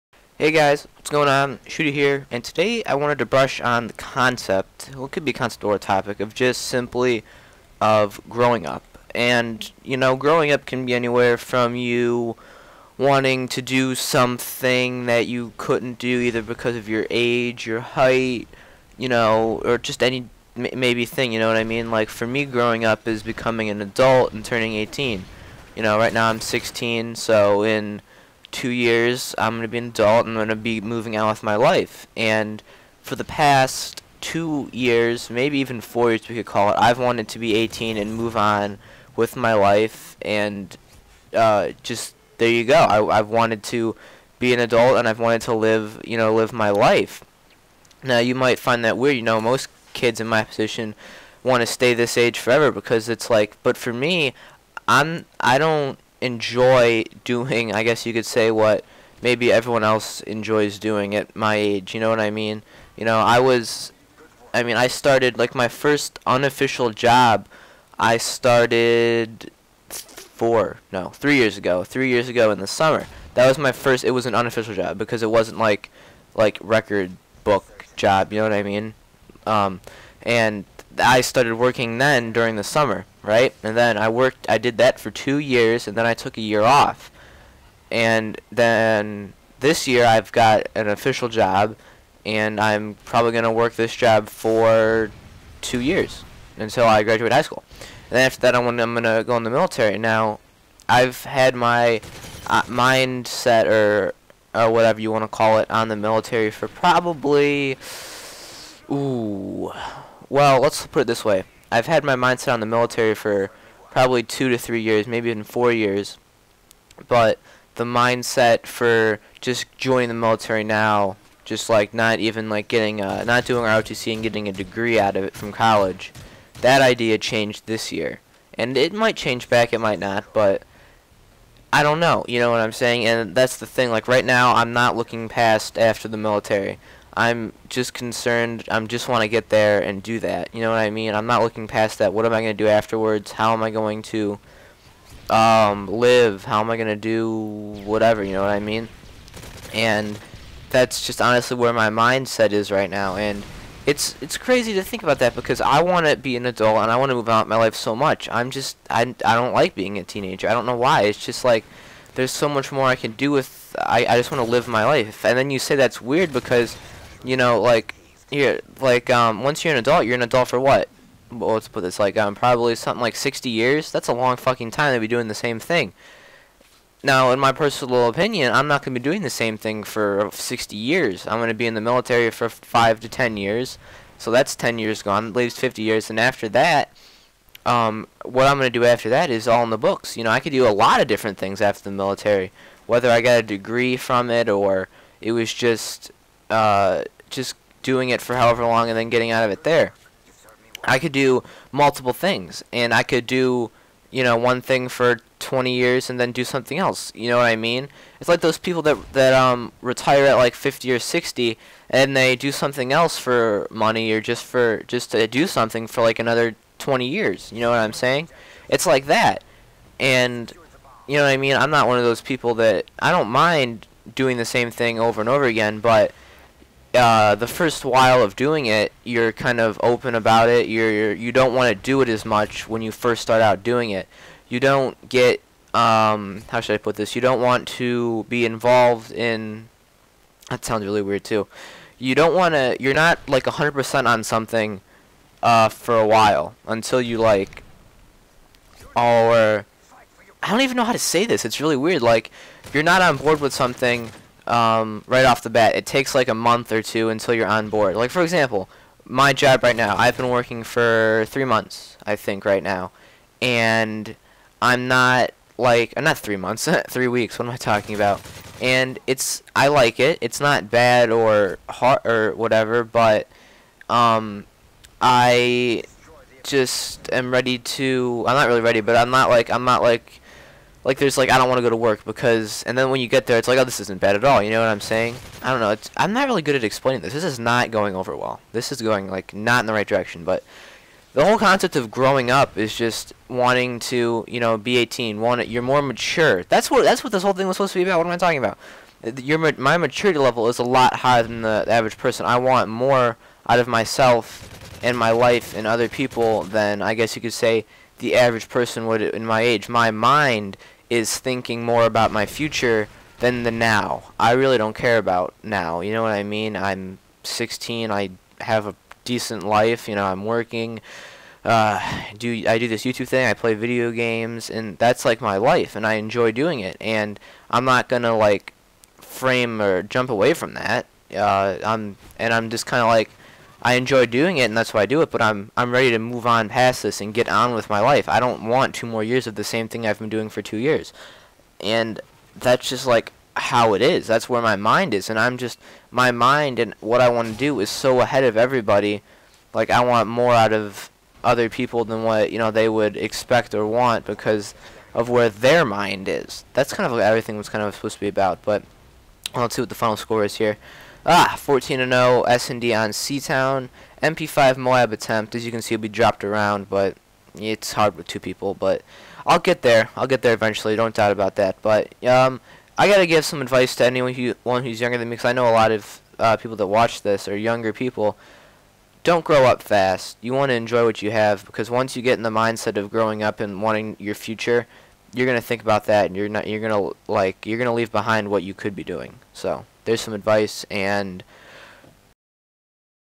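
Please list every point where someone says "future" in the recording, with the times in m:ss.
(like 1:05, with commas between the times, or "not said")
5:12, 6:24.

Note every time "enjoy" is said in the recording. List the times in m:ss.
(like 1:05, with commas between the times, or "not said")
0:56, 1:00, 5:25, 5:33, 6:20.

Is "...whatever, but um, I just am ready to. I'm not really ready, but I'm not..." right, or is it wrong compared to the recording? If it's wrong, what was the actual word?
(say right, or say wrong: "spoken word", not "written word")
right.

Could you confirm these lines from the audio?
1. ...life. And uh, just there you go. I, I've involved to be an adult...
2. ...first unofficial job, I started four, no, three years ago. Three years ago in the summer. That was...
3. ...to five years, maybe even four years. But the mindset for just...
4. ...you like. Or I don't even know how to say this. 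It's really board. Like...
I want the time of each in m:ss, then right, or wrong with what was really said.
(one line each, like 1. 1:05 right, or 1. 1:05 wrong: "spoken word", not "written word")
1. 0:39 wrong: "wanted", not "involved"
2. 1:05 right
3. 1:54 wrong: "three", not "five"
4. 4:07 wrong: "weird", not "board".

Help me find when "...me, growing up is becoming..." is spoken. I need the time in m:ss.
0:22.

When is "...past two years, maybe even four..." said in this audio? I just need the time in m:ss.
0:33.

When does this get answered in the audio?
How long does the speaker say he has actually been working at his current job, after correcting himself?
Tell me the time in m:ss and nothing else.
4:26.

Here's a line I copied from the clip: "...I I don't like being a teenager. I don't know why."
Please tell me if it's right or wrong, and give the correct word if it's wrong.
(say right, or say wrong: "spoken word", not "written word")
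right.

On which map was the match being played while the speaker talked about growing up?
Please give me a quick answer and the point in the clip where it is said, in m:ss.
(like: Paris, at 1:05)
Seatown, at 6:02.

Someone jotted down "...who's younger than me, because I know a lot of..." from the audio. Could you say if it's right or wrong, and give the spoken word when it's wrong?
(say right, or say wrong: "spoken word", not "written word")
right.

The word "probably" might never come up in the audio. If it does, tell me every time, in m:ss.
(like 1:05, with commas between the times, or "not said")
1:33, 1:46, 1:53, 2:52.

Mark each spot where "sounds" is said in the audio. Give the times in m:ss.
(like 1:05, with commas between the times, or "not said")
4:00.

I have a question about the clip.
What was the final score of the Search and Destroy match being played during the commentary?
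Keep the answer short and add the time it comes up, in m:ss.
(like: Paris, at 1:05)
14-0, at 6:01.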